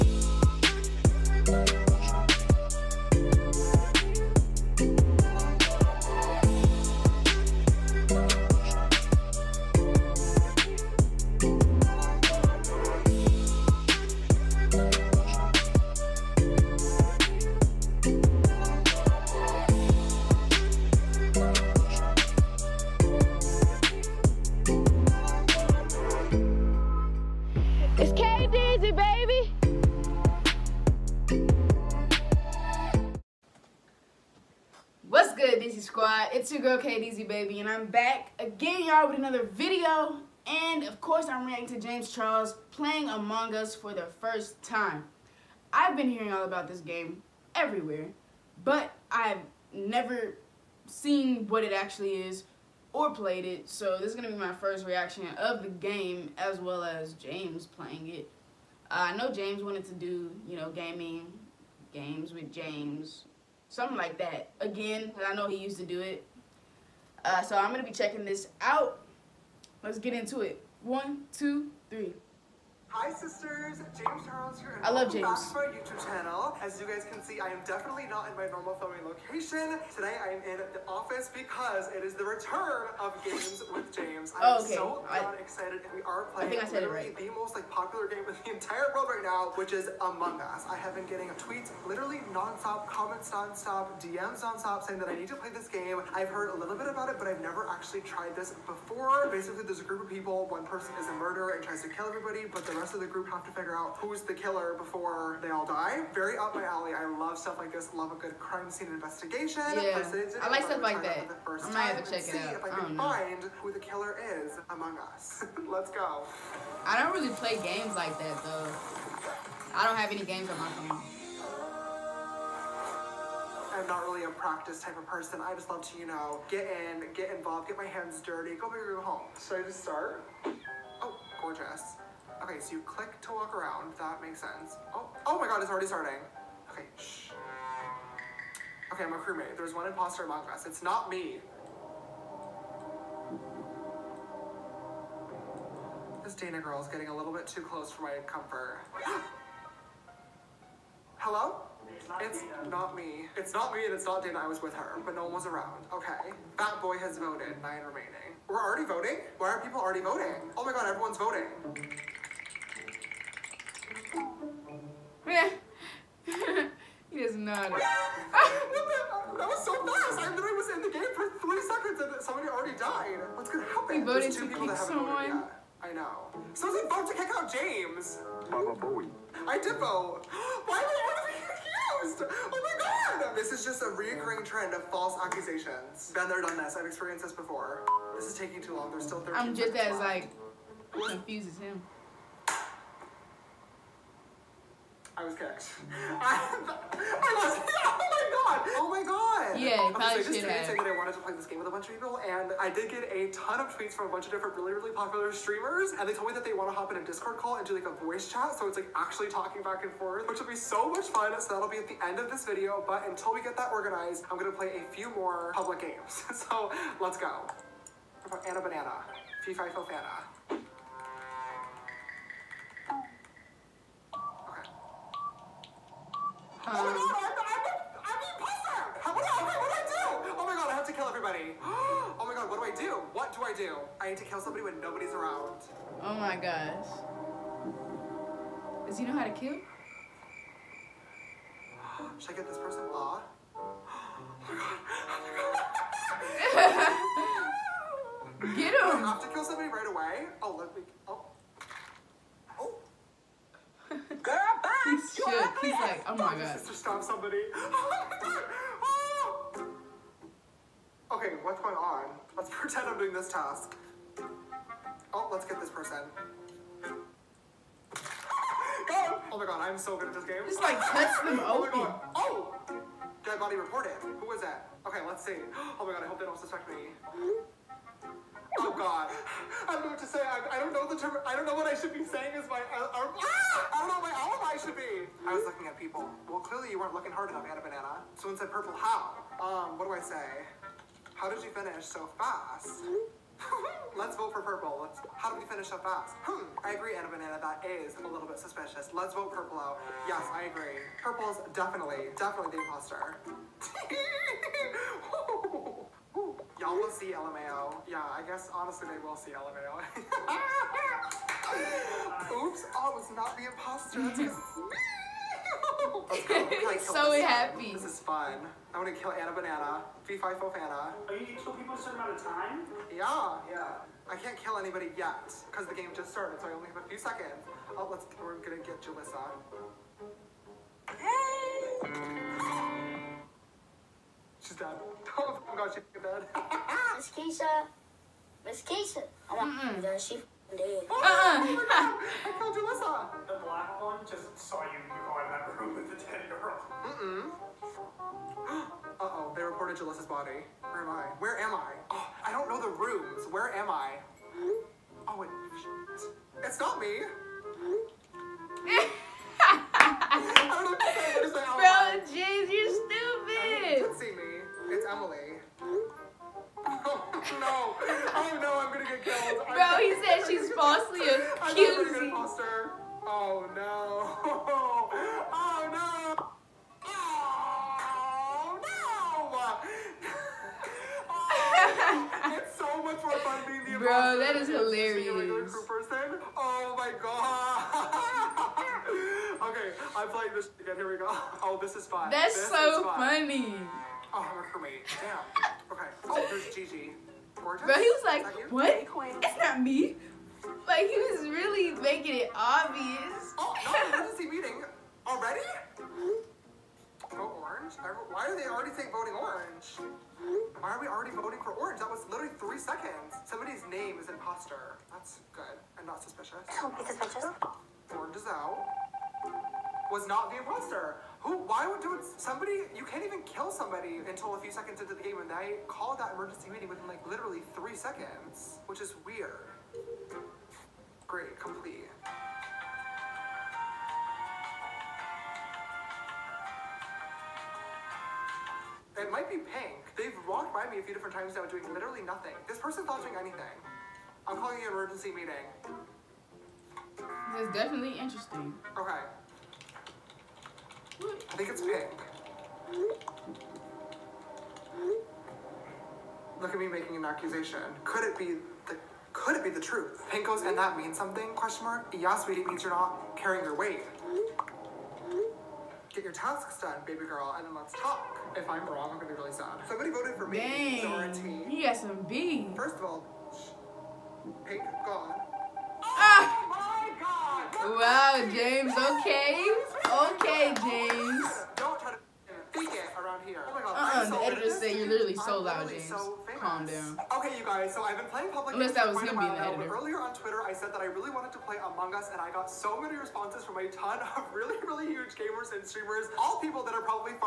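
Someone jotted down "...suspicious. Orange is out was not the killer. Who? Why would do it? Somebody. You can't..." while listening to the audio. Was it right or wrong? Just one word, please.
wrong.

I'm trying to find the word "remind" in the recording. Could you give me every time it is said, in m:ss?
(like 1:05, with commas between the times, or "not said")
not said.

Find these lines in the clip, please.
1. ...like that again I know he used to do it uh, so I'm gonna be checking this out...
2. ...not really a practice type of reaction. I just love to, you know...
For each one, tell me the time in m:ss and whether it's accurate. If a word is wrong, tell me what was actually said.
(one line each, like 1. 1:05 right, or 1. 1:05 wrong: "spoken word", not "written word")
1. 1:03 right
2. 2:03 wrong: "person", not "reaction".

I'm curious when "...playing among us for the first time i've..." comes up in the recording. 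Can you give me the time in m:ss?
0:42.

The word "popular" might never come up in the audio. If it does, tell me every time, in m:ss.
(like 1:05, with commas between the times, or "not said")
1:27, 3:24.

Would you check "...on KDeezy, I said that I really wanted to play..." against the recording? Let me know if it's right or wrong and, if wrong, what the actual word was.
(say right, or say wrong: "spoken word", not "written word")
wrong: "Twitter", not "KDeezy".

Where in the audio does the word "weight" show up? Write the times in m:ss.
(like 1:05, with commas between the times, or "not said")
7:43.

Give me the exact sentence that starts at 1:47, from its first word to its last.
Love a good crime scene investigation.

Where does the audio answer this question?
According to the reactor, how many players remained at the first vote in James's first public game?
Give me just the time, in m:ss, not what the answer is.
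2:37.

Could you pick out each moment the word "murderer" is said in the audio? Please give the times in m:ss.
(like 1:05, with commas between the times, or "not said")
1:41.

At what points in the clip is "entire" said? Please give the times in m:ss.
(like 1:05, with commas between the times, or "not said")
1:28.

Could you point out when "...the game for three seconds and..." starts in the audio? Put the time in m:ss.
2:50.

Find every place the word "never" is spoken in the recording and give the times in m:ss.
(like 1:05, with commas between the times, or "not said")
0:49, 1:37.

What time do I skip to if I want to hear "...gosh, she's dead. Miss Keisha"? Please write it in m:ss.
5:35.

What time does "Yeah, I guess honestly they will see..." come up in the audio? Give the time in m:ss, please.
5:07.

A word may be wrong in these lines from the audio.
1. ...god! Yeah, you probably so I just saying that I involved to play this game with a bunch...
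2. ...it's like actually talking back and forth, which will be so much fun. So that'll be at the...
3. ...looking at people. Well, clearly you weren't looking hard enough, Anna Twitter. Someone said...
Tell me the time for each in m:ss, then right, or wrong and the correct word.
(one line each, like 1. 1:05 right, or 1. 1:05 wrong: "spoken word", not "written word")
1. 3:19 wrong: "wanted", not "involved"
2. 3:28 right
3. 4:45 wrong: "Banana", not "Twitter".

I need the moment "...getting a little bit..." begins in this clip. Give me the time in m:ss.
2:26.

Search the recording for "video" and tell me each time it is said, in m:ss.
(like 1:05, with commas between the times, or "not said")
0:39, 3:32.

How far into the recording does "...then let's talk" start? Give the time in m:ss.
7:47.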